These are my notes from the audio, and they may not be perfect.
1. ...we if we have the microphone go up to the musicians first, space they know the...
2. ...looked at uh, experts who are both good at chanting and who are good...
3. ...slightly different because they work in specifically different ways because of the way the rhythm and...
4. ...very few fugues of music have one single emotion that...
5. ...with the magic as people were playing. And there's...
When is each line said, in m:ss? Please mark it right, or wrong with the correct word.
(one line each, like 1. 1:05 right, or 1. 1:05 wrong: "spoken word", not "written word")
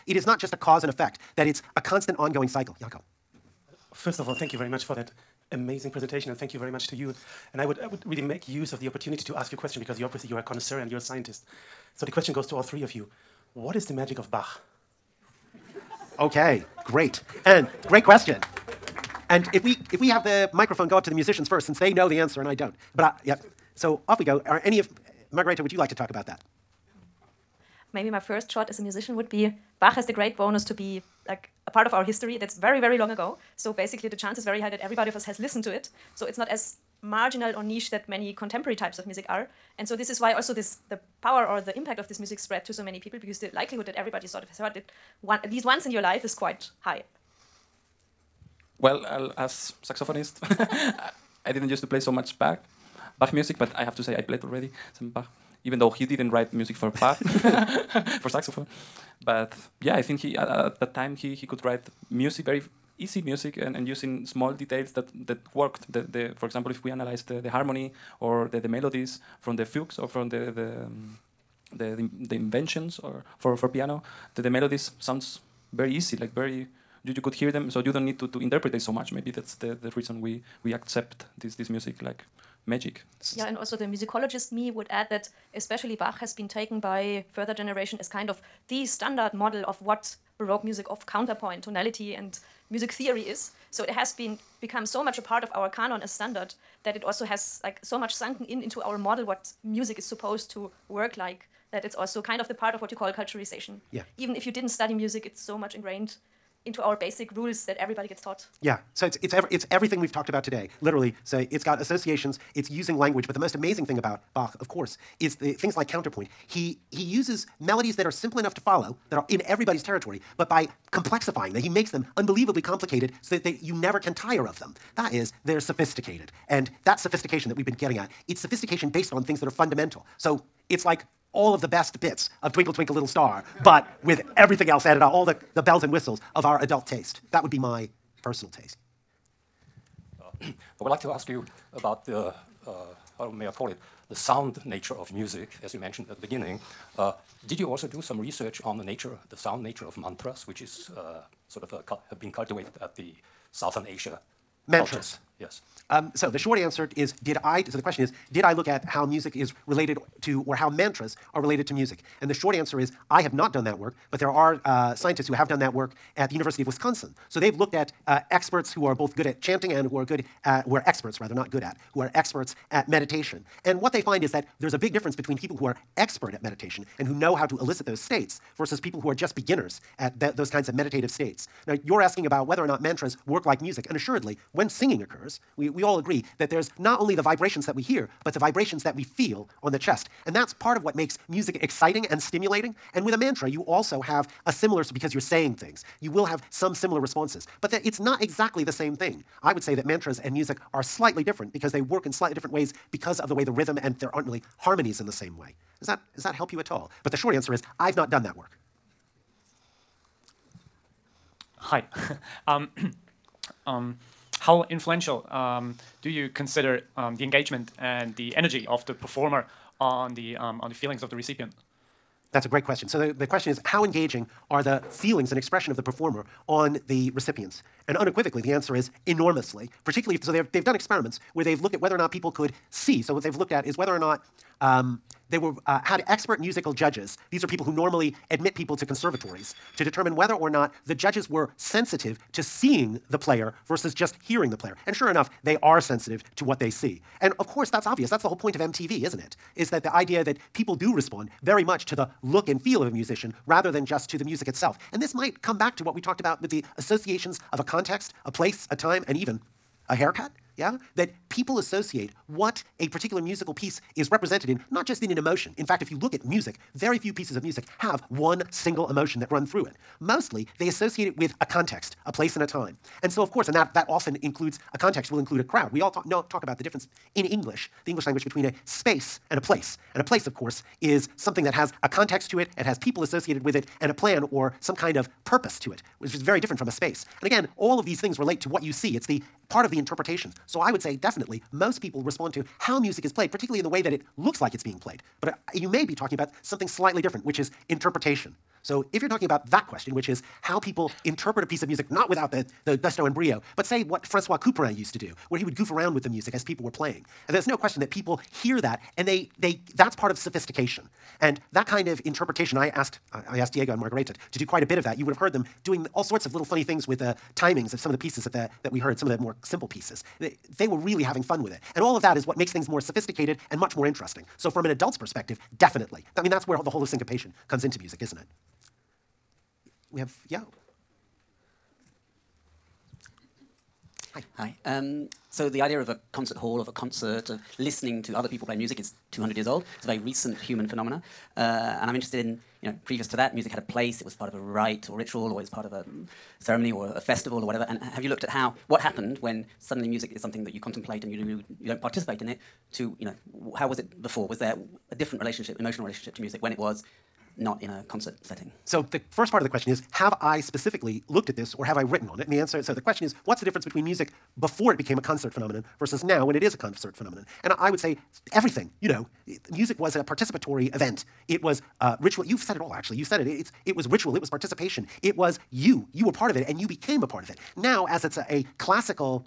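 1. 0:19 wrong: "since", not "space"
2. 2:47 right
3. 3:20 wrong: "slightly", not "specifically"
4. 4:26 wrong: "pieces", not "fugues"
5. 5:05 wrong: "music", not "magic".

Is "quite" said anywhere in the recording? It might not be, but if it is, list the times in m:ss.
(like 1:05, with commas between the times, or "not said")
0:46, 5:14.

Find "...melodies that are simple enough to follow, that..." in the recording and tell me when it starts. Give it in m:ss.
1:57.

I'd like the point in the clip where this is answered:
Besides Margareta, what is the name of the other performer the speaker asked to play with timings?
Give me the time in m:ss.
5:13.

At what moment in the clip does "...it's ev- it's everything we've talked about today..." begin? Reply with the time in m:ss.
1:49.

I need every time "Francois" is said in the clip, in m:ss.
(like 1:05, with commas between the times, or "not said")
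5:04.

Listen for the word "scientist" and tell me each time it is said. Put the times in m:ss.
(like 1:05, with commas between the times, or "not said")
0:10, 2:44.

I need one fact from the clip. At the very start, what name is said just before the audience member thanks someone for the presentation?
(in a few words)
Jakob.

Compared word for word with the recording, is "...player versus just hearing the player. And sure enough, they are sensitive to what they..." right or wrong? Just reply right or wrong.
right.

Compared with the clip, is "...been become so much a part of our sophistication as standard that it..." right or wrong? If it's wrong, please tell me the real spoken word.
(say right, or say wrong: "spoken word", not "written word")
wrong: "canon", not "sophistication".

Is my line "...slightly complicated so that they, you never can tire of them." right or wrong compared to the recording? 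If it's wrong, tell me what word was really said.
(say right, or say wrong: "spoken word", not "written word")
wrong: "unbelievably", not "slightly".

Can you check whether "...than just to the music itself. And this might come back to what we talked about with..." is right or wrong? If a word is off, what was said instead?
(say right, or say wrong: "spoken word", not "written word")
right.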